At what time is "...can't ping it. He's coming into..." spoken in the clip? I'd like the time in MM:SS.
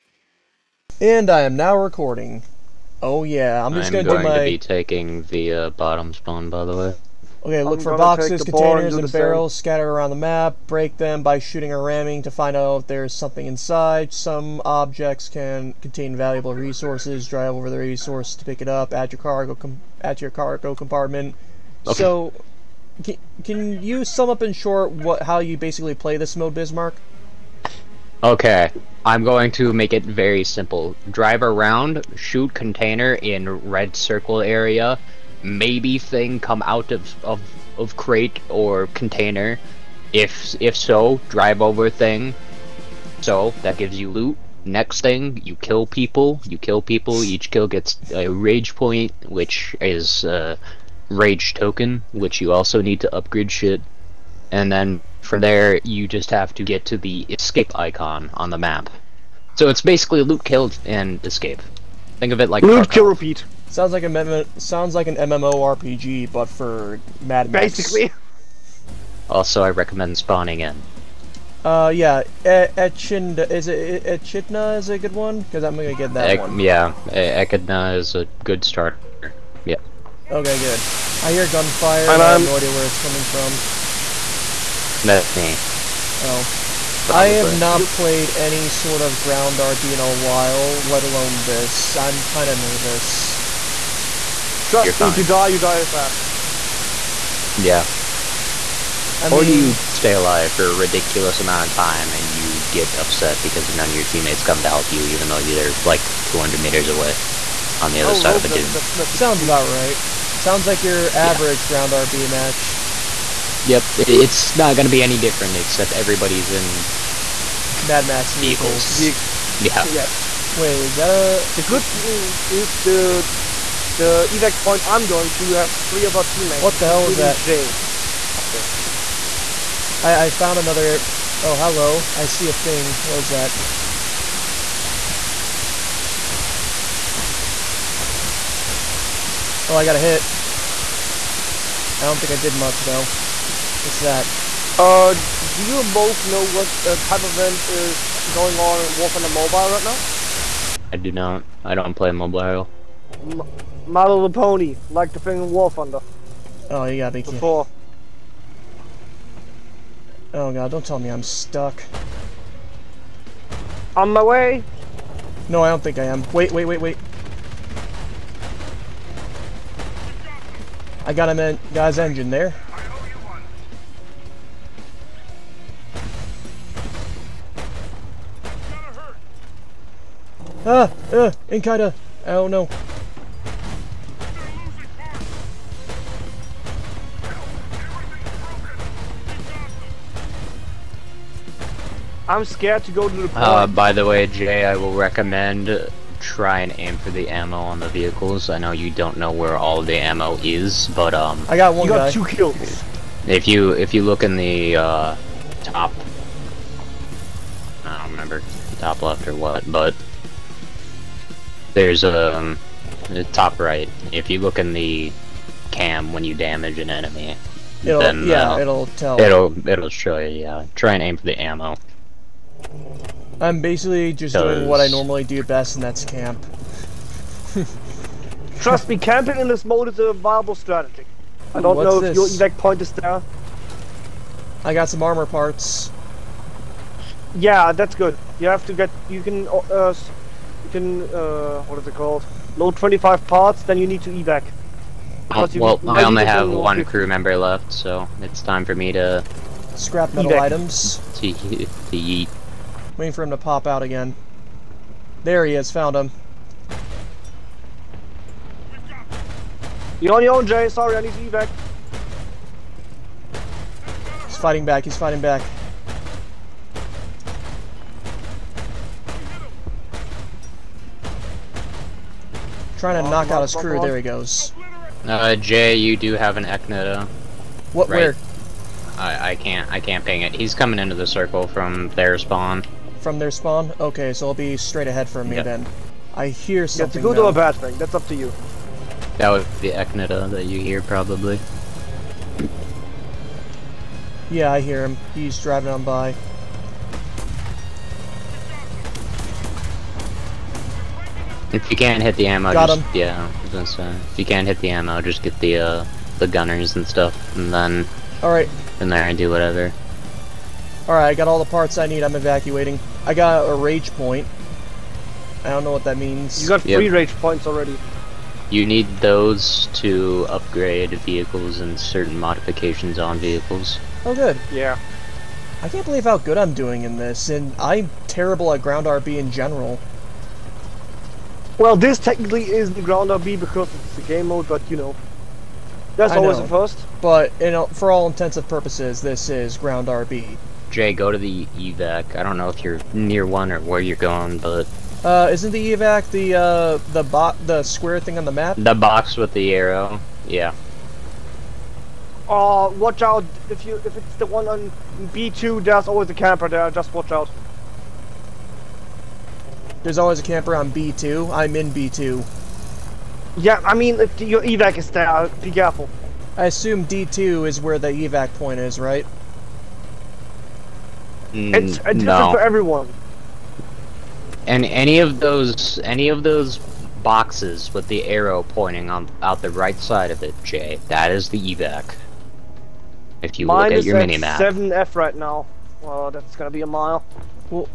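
04:39.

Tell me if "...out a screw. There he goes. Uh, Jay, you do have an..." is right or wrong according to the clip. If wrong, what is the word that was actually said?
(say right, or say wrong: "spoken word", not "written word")
right.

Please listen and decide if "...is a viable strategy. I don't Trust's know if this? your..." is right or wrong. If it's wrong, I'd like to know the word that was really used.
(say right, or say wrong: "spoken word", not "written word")
wrong: "What", not "Trust".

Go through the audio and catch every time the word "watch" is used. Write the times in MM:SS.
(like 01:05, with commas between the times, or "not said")
05:52, 05:56.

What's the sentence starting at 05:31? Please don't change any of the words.
Well, this technically is the ground RB because it's the game mode, but you know, that's I always know, a first.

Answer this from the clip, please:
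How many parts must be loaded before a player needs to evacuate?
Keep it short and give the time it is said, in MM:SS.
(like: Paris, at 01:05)
25, at 04:02.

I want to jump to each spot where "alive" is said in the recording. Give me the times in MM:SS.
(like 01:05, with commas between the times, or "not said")
01:40.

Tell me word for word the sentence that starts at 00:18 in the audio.
Add your cargo com- at your cargo compartment.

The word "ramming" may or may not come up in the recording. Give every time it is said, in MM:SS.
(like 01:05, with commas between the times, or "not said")
00:11.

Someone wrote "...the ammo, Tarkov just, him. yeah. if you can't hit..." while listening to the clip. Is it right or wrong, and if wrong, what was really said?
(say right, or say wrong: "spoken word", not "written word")
wrong: "Got", not "Tarkov".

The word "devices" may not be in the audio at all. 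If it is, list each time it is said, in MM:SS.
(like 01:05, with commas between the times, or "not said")
not said.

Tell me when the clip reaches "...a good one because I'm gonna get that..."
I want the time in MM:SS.
01:14.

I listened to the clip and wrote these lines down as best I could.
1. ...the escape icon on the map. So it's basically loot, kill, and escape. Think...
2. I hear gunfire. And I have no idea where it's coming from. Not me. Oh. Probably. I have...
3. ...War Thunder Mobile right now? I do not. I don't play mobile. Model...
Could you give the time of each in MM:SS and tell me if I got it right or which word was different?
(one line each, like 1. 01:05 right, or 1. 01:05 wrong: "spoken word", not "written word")
1. 00:56 right
2. 01:21 right
3. 02:28 right.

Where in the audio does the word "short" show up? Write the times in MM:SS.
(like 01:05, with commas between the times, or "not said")
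00:24.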